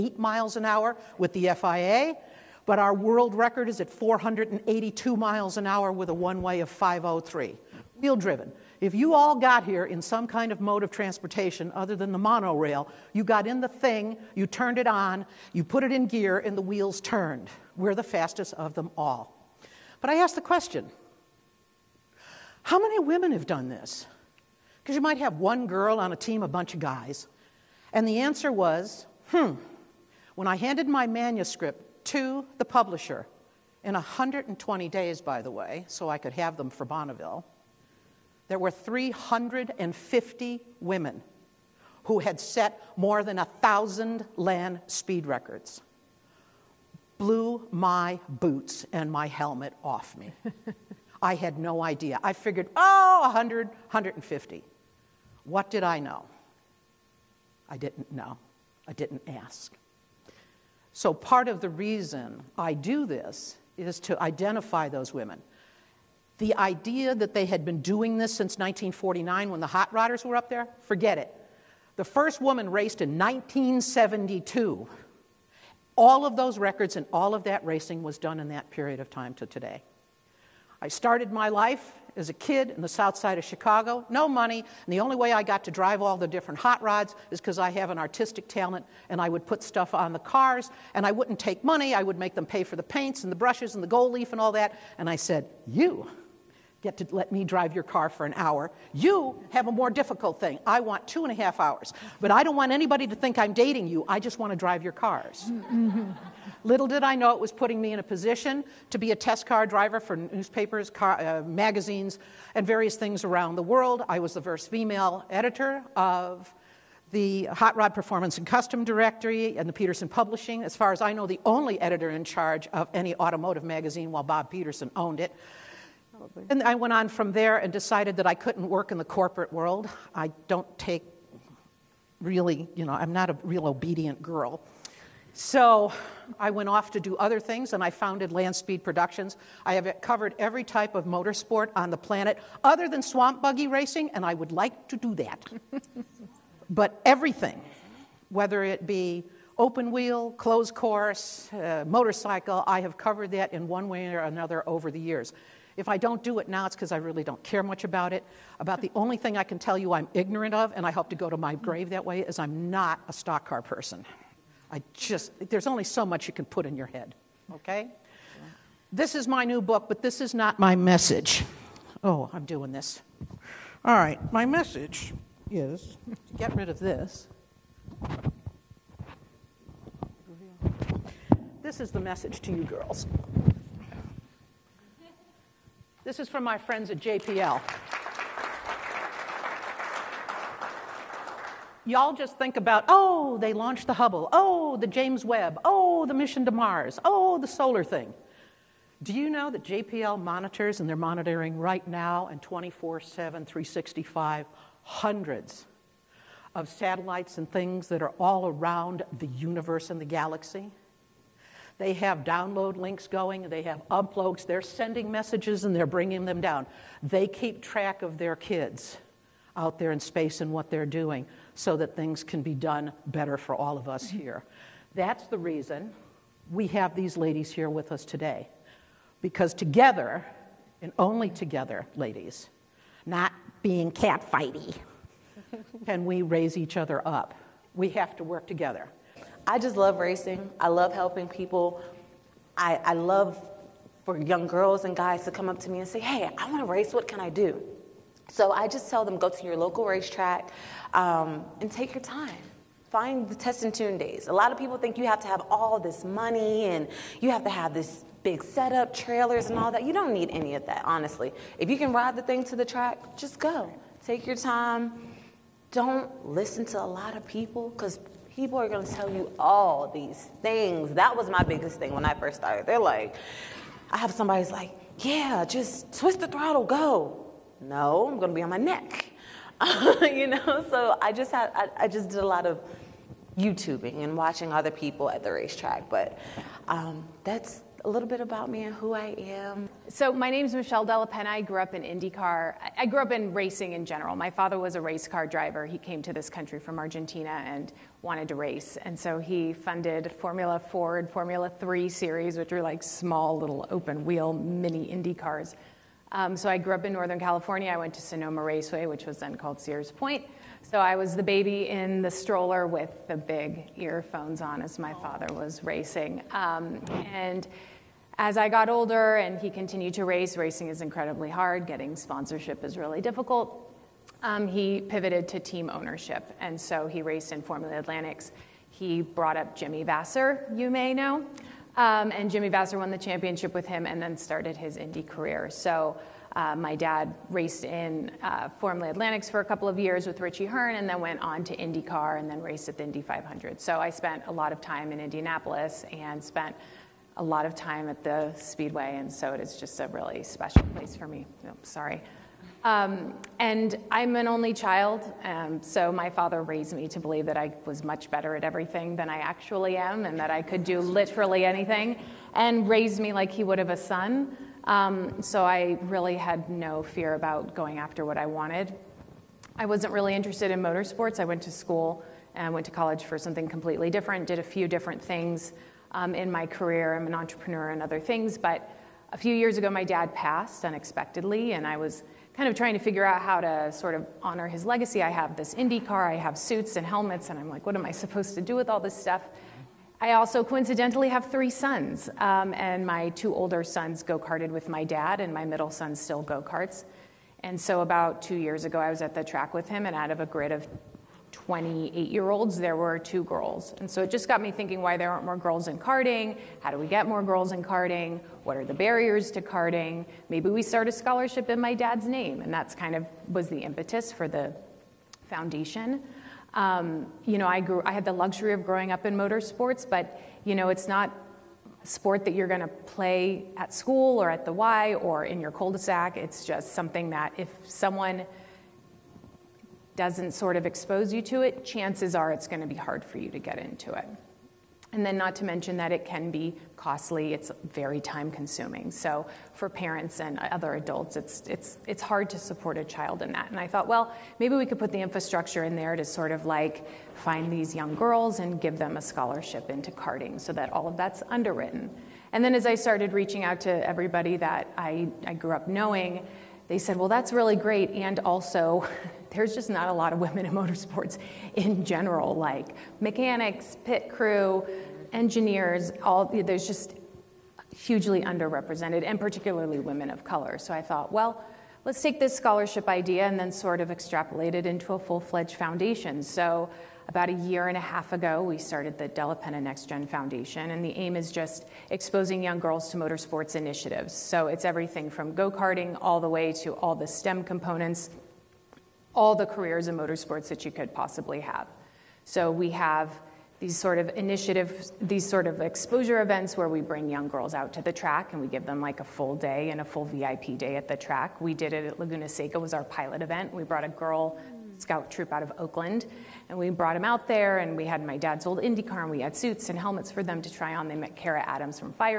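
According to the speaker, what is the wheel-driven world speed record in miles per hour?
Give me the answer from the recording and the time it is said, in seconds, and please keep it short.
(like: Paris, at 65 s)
482, at 3 s.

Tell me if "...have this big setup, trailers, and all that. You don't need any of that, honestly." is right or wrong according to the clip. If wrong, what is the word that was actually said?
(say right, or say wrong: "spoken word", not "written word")
right.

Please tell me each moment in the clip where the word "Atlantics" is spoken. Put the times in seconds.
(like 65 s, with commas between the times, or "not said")
327 s, 338 s.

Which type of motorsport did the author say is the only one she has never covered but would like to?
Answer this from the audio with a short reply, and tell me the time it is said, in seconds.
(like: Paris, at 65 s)
swamp buggy racing, at 143 s.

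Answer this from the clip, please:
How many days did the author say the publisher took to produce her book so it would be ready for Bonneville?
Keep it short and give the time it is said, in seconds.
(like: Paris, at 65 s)
120, at 33 s.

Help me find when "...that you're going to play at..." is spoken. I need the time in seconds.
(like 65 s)
422 s.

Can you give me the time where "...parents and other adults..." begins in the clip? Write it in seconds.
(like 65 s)
439 s.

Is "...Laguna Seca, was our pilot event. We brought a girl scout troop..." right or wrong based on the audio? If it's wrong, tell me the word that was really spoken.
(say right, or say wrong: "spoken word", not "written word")
right.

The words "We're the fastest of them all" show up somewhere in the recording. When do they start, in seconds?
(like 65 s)
17 s.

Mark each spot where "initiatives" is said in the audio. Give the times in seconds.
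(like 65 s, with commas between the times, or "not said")
483 s, 494 s.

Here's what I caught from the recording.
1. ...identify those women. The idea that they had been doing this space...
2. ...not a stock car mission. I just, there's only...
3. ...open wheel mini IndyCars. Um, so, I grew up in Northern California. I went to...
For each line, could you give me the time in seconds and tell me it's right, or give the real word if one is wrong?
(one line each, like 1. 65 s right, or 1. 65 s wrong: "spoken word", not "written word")
1. 64 s wrong: "since", not "space"
2. 162 s wrong: "person", not "mission"
3. 303 s right.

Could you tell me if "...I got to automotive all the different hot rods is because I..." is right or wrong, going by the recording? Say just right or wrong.
wrong.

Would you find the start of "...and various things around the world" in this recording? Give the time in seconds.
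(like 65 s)
112 s.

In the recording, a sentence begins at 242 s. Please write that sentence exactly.
I, I love for young girls and guys to come up to me and say, hey, I want to race.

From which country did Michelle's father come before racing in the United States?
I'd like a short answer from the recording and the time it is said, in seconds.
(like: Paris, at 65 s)
Argentina, at 296 s.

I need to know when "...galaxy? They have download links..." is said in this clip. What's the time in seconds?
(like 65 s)
210 s.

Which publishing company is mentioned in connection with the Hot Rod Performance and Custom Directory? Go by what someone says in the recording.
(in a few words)
Petersen Publishing.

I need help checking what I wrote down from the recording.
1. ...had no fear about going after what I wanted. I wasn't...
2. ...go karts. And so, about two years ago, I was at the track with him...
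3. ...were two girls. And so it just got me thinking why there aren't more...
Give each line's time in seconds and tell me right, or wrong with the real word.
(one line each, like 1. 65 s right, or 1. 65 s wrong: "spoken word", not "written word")
1. 366 s right
2. 396 s right
3. 402 s right.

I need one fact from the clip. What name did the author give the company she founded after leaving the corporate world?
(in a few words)
Land Speed Productions.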